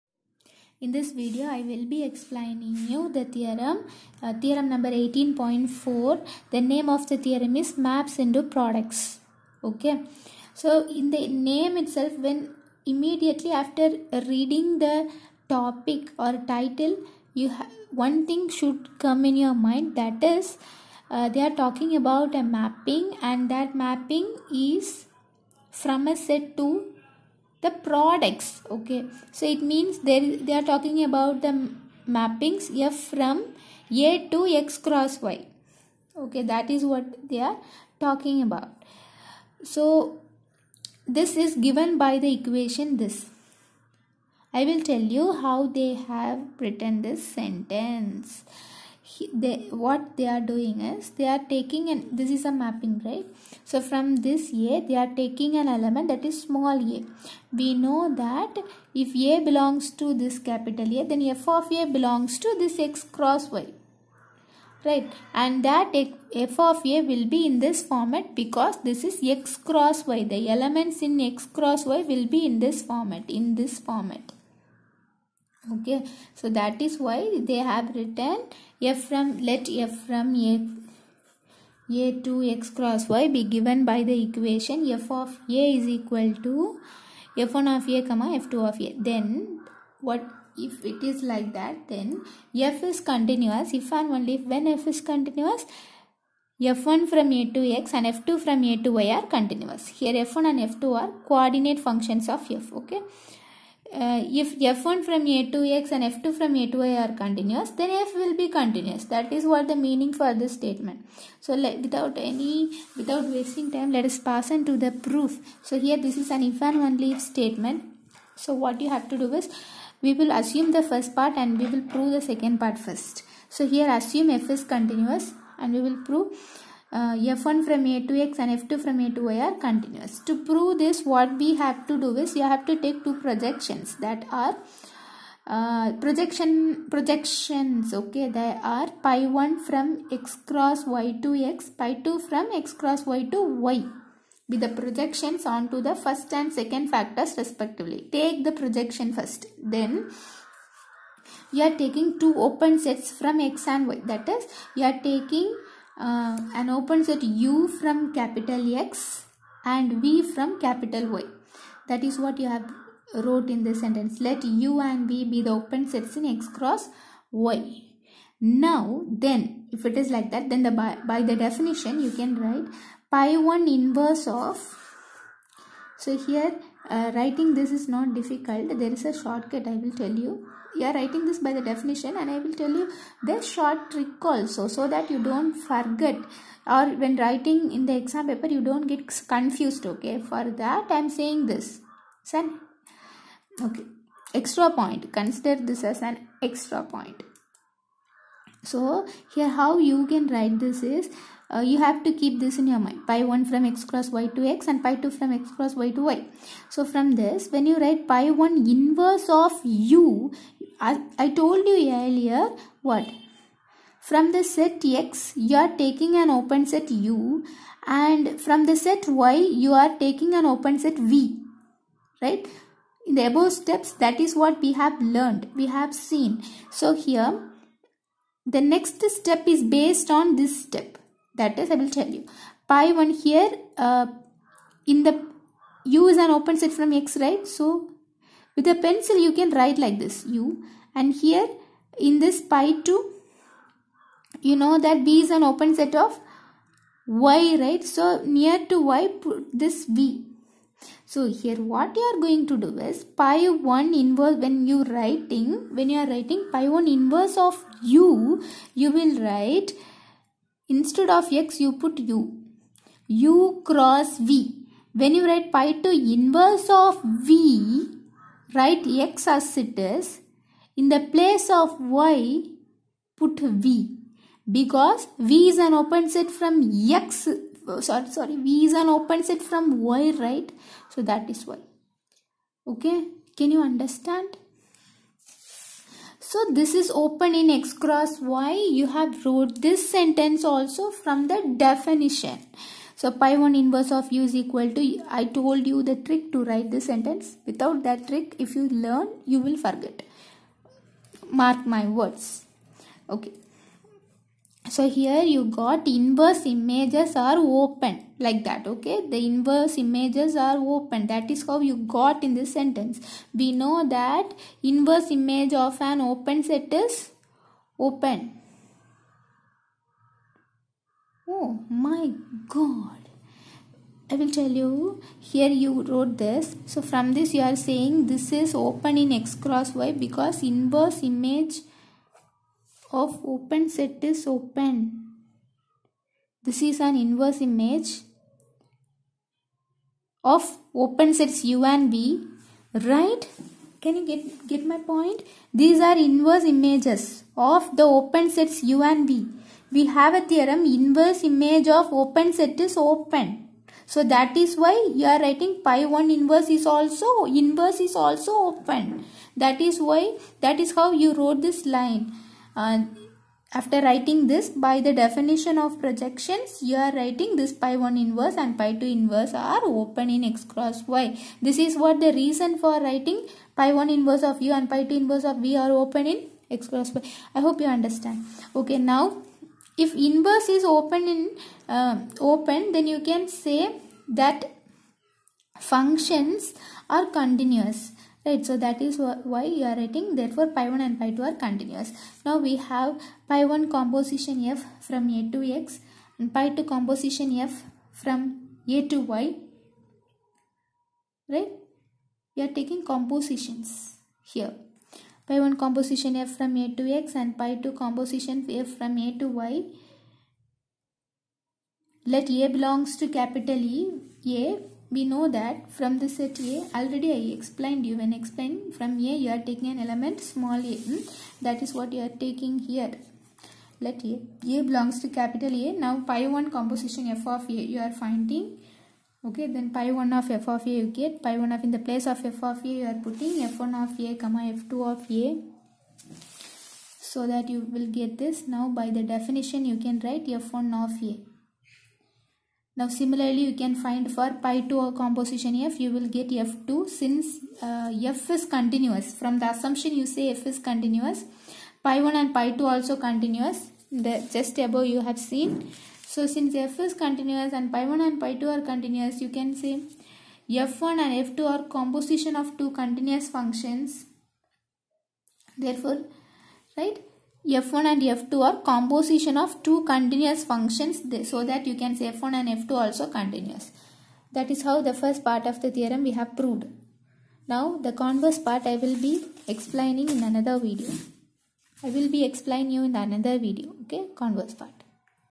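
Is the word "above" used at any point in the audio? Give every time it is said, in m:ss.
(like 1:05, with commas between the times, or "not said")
3:43, 7:34.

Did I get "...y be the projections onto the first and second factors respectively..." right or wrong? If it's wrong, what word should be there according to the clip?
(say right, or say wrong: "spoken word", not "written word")
right.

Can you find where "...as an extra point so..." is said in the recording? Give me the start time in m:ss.
3:15.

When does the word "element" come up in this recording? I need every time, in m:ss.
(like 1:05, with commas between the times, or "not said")
0:55, 1:10, 6:59.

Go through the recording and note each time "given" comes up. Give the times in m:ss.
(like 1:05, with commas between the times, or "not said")
0:41, 1:23.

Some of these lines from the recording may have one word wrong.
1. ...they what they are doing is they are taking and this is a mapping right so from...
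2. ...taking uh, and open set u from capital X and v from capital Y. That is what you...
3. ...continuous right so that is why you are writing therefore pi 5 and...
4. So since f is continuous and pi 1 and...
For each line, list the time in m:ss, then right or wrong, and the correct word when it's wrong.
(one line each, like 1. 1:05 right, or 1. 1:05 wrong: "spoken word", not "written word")
1. 0:49 right
2. 2:35 right
3. 6:27 wrong: "1", not "5"
4. 7:36 right.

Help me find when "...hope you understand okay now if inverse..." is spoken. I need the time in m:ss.
6:17.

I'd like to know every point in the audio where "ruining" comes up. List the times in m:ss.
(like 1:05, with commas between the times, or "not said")
not said.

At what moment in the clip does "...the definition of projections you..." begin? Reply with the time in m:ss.
6:04.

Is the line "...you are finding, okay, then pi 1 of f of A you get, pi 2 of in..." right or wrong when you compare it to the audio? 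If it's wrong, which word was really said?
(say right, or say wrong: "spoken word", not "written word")
wrong: "1", not "2".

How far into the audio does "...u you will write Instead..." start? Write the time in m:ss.
4:17.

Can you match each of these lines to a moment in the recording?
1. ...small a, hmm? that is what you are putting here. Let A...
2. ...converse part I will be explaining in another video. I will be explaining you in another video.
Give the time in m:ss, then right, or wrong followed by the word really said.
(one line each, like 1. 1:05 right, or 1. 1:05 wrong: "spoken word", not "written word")
1. 7:00 wrong: "taking", not "putting"
2. 7:57 right.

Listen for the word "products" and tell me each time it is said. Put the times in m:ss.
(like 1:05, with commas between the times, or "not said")
0:08, 0:27.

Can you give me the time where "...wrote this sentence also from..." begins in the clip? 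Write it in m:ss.
4:49.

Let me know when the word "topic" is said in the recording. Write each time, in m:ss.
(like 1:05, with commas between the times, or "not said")
0:15.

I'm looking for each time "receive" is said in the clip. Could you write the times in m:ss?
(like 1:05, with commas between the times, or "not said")
not said.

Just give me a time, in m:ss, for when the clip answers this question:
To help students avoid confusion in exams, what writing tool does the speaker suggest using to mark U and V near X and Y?
3:58.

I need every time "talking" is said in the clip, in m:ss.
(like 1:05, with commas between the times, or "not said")
0:21, 0:30, 0:37.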